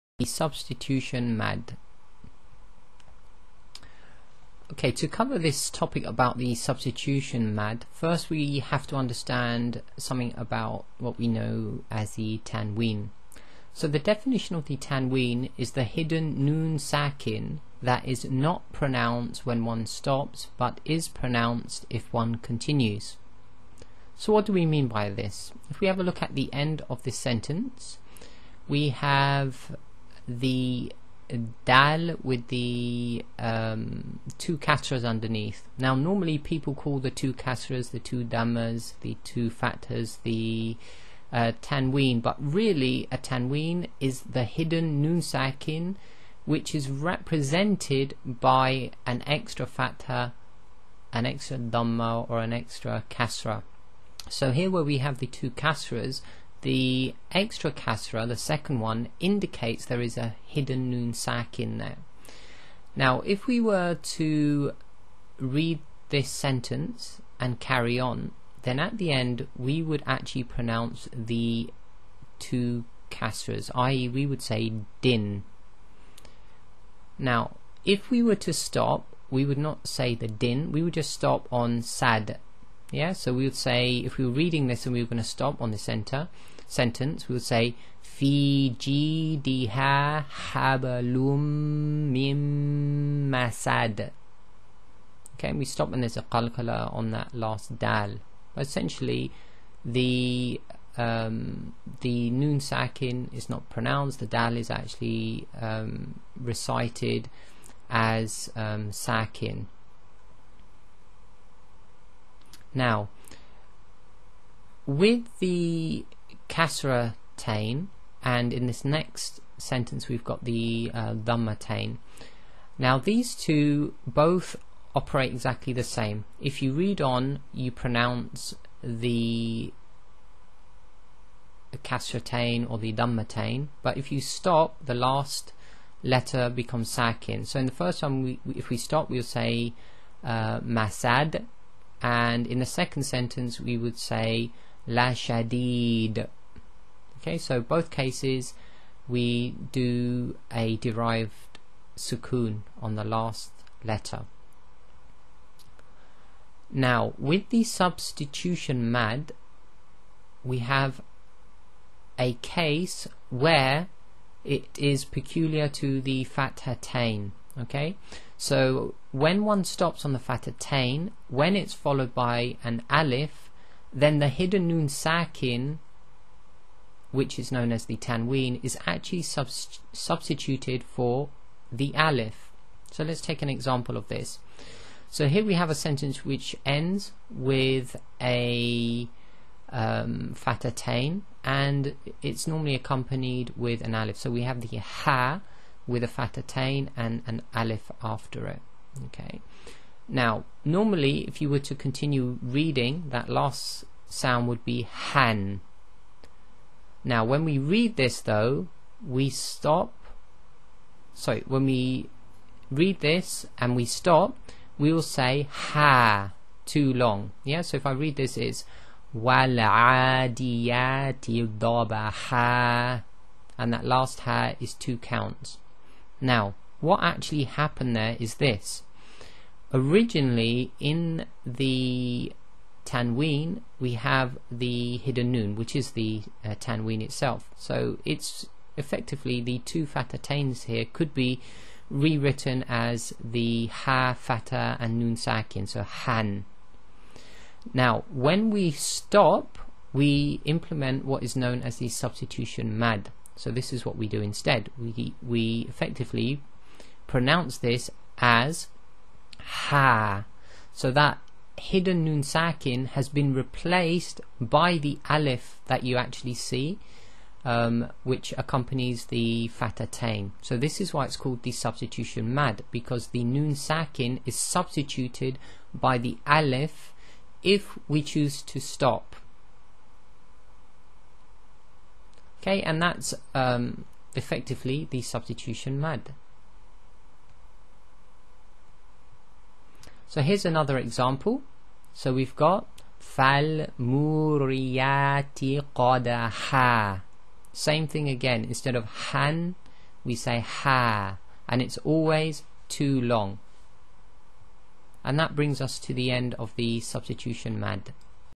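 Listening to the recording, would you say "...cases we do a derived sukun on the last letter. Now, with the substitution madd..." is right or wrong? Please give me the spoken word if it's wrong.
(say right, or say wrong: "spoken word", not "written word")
right.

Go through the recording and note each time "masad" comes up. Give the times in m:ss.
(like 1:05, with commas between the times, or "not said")
1:33, 2:20.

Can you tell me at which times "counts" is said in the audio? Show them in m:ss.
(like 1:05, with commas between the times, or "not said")
3:44.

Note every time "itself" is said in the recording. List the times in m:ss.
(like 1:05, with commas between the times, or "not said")
3:57.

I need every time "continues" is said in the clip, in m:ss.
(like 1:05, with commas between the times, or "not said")
0:22, 3:21.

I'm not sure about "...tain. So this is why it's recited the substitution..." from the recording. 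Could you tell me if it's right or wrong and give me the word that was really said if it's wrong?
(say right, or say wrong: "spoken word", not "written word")
wrong: "called", not "recited".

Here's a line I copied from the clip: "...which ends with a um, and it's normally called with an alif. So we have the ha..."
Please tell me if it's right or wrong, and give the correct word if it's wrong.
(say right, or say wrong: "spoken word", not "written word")
wrong: "accompanied", not "called".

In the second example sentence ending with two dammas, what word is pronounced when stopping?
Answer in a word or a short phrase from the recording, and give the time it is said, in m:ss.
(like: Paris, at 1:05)
La Shadid, at 2:24.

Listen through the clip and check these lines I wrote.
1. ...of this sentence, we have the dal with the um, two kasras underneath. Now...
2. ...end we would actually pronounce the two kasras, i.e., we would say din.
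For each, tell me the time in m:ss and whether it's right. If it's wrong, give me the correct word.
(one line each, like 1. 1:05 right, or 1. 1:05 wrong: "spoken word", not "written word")
1. 0:26 right
2. 1:09 right.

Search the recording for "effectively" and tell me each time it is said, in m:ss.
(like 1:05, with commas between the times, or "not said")
3:58, 4:15, 4:44.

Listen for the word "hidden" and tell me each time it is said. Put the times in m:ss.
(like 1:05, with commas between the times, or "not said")
0:15, 0:44, 1:00, 2:54, 3:54, 4:21.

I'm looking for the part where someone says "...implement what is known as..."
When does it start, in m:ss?
4:10.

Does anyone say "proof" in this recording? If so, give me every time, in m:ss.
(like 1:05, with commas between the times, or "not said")
not said.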